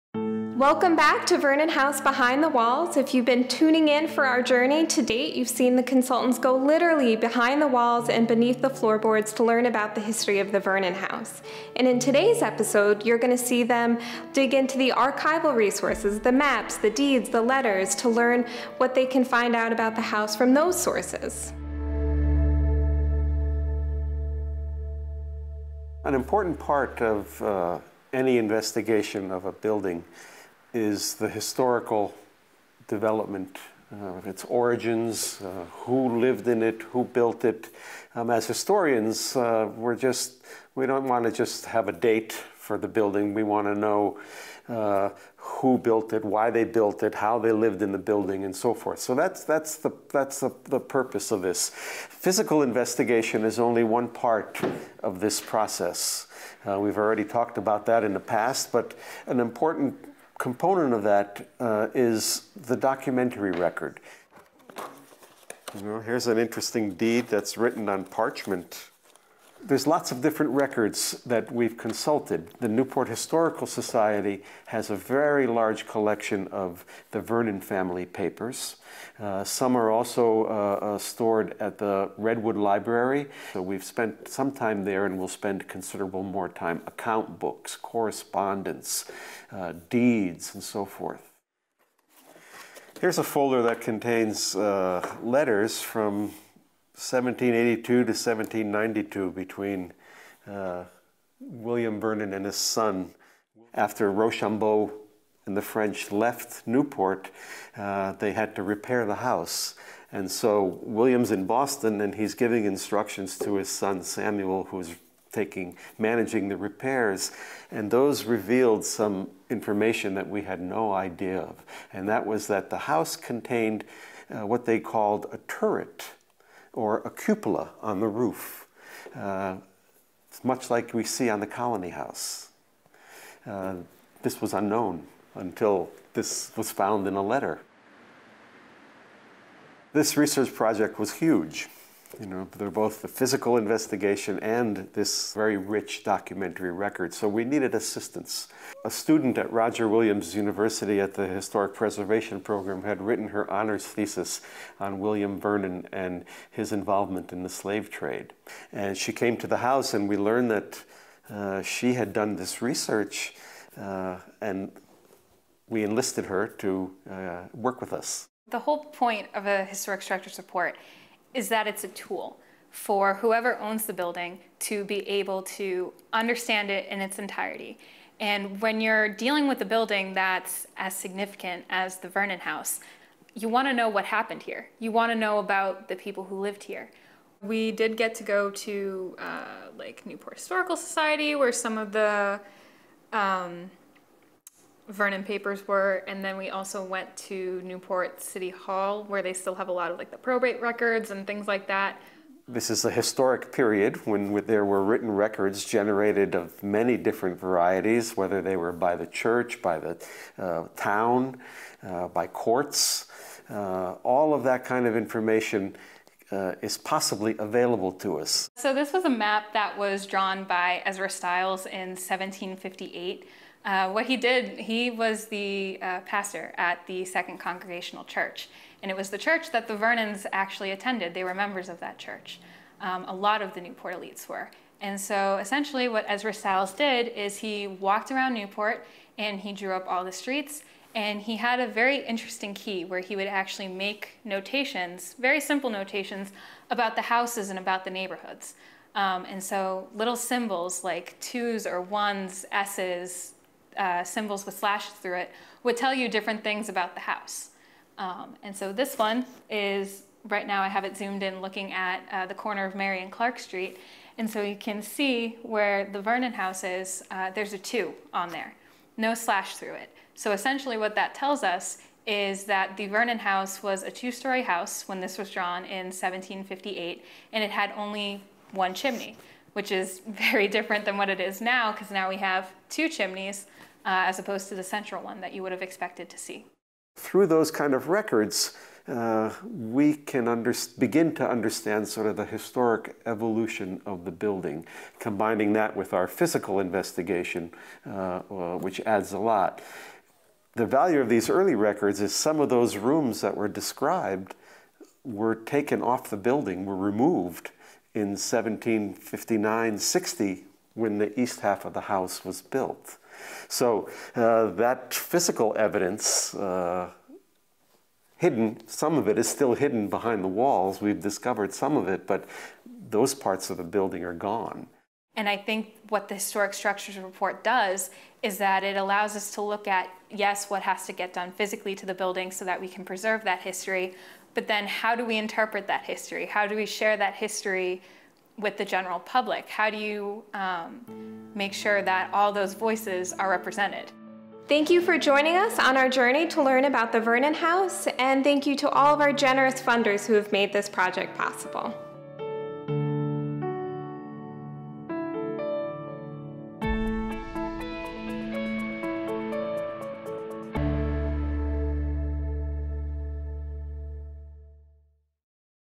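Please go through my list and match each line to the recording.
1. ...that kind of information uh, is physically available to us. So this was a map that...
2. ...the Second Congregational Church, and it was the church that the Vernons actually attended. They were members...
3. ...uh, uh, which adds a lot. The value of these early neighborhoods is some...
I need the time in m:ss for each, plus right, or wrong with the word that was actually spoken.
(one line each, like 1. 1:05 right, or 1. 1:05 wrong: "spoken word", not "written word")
1. 3:34 wrong: "possibly", not "physically"
2. 3:46 right
3. 4:57 wrong: "records", not "neighborhoods".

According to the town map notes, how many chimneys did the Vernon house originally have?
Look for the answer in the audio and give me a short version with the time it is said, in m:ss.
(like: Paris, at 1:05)
1, at 4:38.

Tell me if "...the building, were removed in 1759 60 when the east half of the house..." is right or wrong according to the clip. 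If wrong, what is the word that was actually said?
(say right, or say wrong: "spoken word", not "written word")
right.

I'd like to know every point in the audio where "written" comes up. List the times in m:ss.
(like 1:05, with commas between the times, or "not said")
1:07, 2:33, 3:24.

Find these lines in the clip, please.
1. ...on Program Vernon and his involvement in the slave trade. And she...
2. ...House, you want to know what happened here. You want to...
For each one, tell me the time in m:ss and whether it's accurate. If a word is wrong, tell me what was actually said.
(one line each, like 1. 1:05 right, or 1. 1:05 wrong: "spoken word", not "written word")
1. 2:34 wrong: "William", not "Program"
2. 3:02 right.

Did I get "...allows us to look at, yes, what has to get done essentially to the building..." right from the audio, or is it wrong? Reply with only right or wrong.
wrong.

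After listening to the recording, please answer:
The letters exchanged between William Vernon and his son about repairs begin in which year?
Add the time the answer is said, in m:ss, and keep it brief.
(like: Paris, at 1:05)
1782, at 1:37.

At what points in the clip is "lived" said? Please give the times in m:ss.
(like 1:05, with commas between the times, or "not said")
0:36, 0:47, 3:06.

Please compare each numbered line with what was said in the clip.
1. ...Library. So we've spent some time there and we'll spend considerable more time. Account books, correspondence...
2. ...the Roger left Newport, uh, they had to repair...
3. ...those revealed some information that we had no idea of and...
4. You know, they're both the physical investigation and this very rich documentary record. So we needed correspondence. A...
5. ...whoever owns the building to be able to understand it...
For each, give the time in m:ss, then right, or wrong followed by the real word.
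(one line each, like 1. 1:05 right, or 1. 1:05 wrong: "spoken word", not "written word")
1. 1:22 right
2. 1:45 wrong: "French", not "Roger"
3. 1:57 right
4. 2:22 wrong: "assistance", not "correspondence"
5. 2:53 right.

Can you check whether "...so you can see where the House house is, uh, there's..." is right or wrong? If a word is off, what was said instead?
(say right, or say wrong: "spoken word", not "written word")
wrong: "Vernon", not "House".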